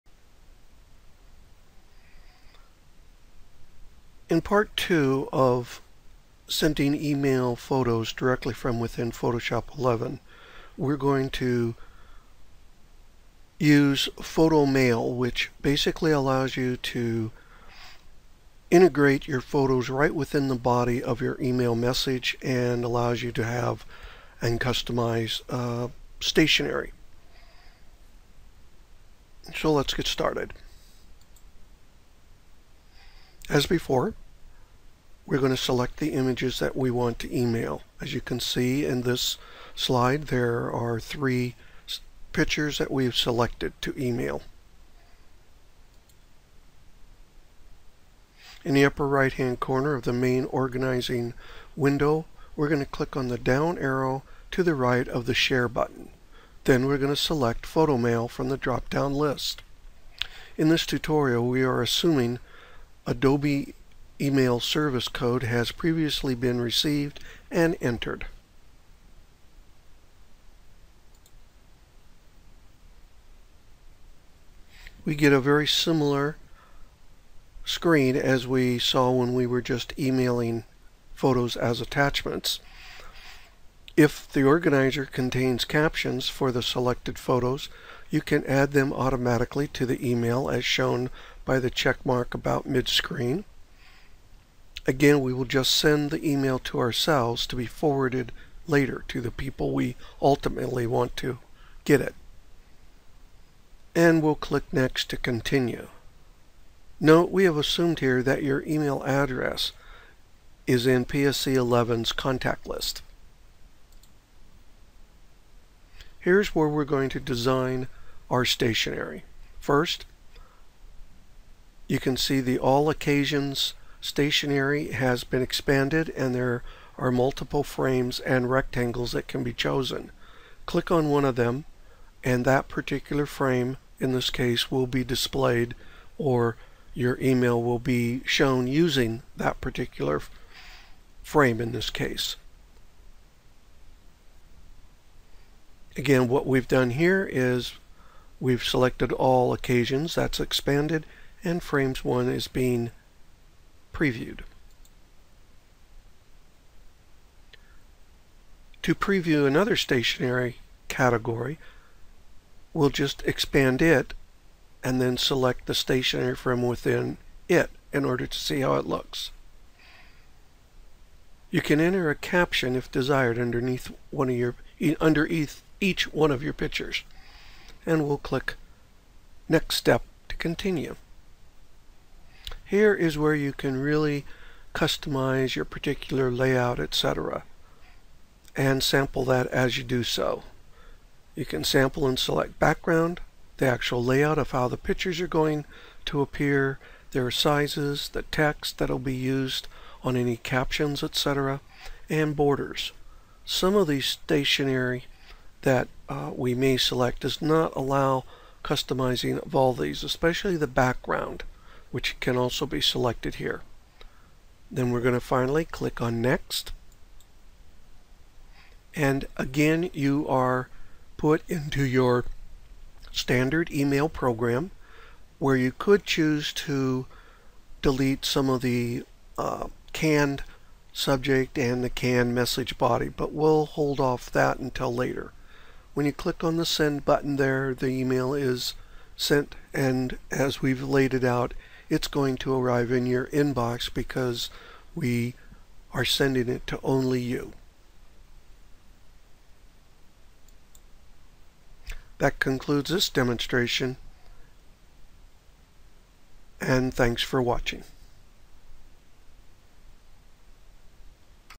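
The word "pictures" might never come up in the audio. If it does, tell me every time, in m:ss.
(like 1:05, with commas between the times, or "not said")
0:42, 2:56, 3:14.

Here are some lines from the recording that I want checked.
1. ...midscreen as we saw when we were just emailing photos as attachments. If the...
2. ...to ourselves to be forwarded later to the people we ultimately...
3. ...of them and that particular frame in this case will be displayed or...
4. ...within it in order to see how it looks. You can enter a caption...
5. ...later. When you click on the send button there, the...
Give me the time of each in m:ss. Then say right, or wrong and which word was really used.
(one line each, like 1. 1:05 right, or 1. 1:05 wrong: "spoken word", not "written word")
1. 1:17 wrong: "screen", not "midscreen"
2. 1:36 right
3. 2:11 right
4. 2:46 right
5. 3:54 right.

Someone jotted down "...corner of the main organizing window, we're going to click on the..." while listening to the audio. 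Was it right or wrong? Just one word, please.
right.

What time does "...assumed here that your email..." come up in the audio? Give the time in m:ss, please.
1:47.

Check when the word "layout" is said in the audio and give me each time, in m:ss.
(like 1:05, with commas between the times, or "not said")
3:06, 3:14.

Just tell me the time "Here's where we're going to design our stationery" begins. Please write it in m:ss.
1:56.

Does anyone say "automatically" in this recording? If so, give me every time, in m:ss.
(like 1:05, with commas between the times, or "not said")
1:28.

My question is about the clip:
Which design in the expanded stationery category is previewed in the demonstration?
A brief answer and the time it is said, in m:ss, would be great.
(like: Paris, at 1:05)
Frames 1, at 2:31.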